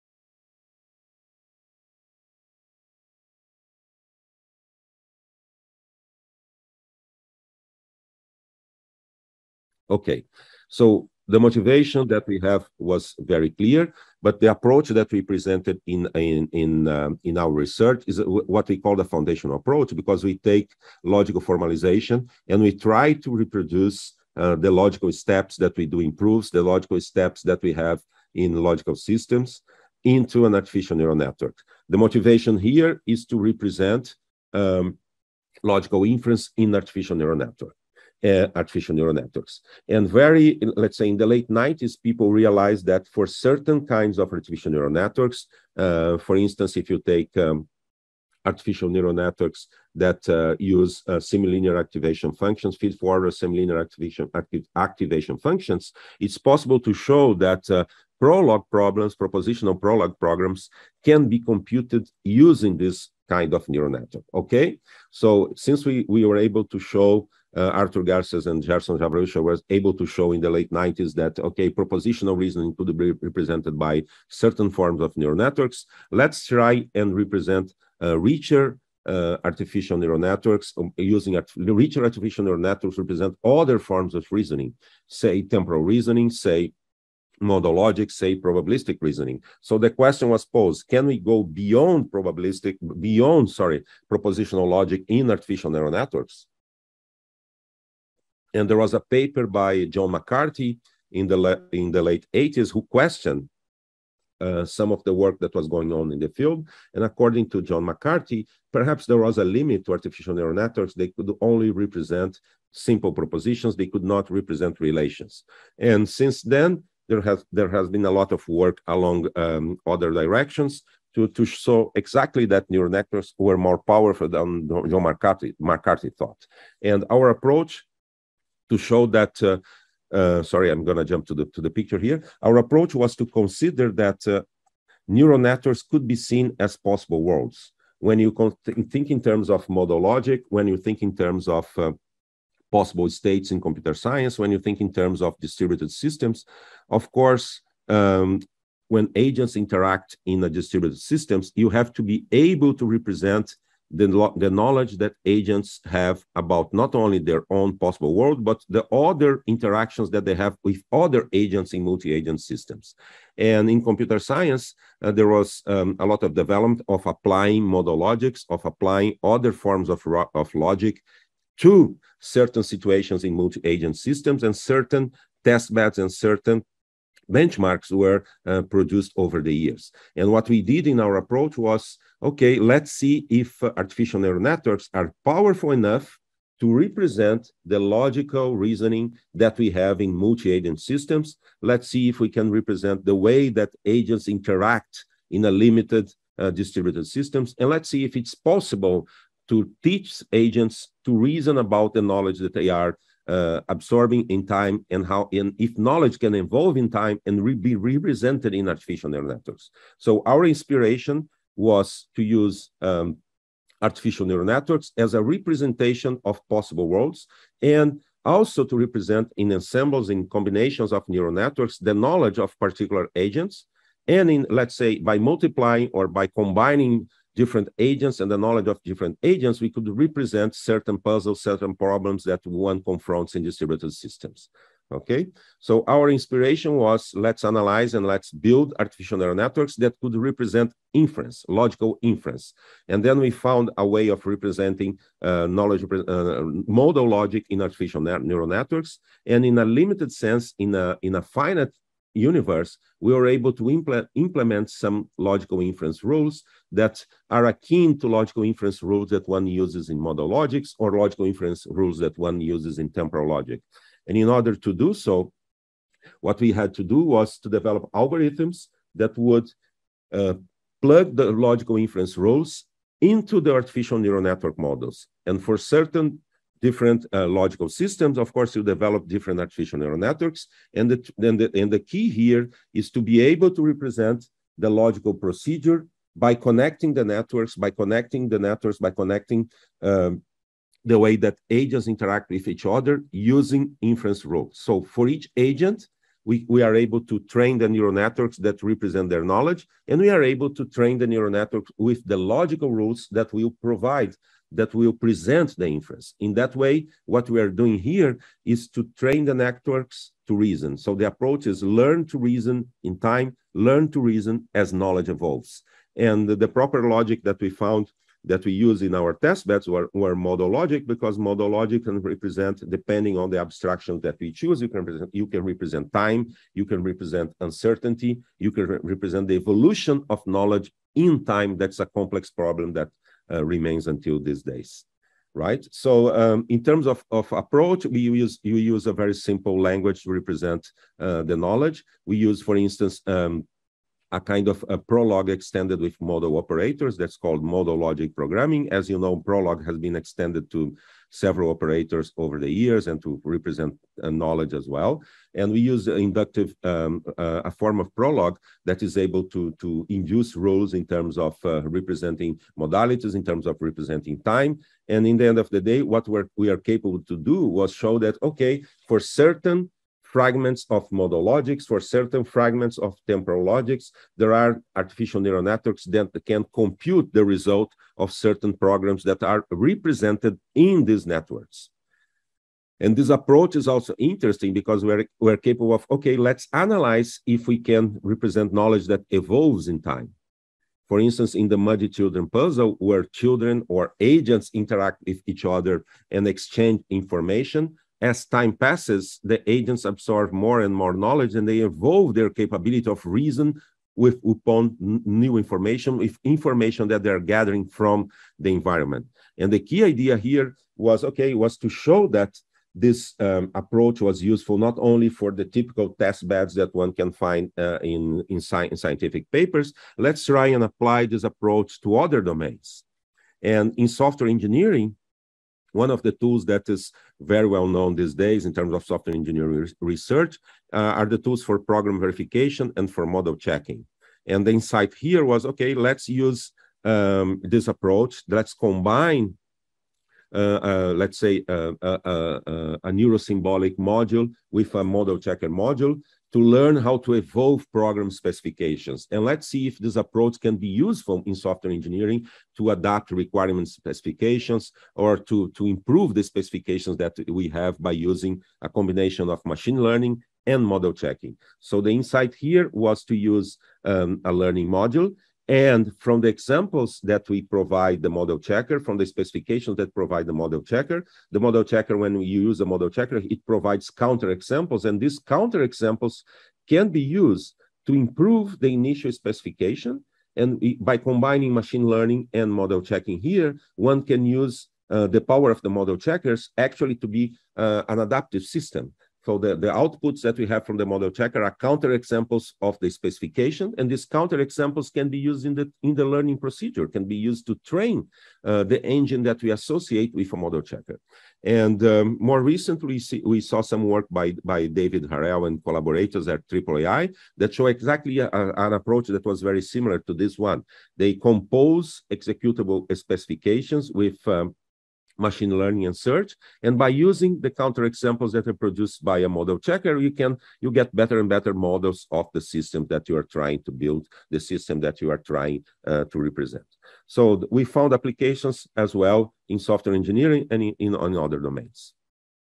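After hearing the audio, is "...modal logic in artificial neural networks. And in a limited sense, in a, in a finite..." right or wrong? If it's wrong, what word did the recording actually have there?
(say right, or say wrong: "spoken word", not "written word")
right.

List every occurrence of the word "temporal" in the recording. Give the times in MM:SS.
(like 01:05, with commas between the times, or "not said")
01:25, 04:22, 06:13.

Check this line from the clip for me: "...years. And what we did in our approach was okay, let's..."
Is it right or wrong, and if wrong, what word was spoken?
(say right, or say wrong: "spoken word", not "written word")
right.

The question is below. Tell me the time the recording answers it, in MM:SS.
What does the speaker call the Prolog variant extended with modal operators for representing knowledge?
05:47.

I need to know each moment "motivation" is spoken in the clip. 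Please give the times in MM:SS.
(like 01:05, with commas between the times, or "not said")
00:11, 00:32.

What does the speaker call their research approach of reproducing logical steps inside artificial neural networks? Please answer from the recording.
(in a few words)
foundational approach.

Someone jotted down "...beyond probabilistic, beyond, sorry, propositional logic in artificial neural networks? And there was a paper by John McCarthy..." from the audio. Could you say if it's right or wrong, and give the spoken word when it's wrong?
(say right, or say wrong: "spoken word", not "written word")
right.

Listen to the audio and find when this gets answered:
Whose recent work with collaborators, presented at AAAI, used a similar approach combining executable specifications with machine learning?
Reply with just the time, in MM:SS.
08:24.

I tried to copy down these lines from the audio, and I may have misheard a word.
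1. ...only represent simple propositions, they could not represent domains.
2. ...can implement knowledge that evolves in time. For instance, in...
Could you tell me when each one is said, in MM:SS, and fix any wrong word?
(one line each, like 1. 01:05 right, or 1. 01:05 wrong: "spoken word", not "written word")
1. 01:51 wrong: "relations", not "domains"
2. 06:27 wrong: "represent", not "implement".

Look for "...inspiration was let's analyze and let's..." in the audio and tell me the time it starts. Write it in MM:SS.
03:56.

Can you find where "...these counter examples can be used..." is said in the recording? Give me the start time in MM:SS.
07:54.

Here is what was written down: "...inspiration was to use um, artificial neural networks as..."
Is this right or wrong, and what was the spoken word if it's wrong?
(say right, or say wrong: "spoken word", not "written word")
right.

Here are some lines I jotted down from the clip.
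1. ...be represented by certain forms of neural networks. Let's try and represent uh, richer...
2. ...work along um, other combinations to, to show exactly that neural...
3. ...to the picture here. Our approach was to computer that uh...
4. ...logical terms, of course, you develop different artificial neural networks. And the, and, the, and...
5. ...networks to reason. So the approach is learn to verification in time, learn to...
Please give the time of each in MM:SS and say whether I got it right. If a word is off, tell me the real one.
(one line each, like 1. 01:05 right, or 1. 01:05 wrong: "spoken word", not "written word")
1. 01:12 right
2. 01:58 wrong: "directions", not "combinations"
3. 02:11 wrong: "consider", not "computer"
4. 04:37 wrong: "systems", not "terms"
5. 05:09 wrong: "reason", not "verification".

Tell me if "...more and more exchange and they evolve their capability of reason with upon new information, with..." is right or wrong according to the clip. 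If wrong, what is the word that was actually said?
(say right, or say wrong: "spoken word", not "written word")
wrong: "knowledge", not "exchange".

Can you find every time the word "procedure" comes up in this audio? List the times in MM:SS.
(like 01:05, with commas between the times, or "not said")
04:45, 08:16.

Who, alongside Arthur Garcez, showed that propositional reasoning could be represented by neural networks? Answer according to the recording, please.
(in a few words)
Gerson Zaverucha.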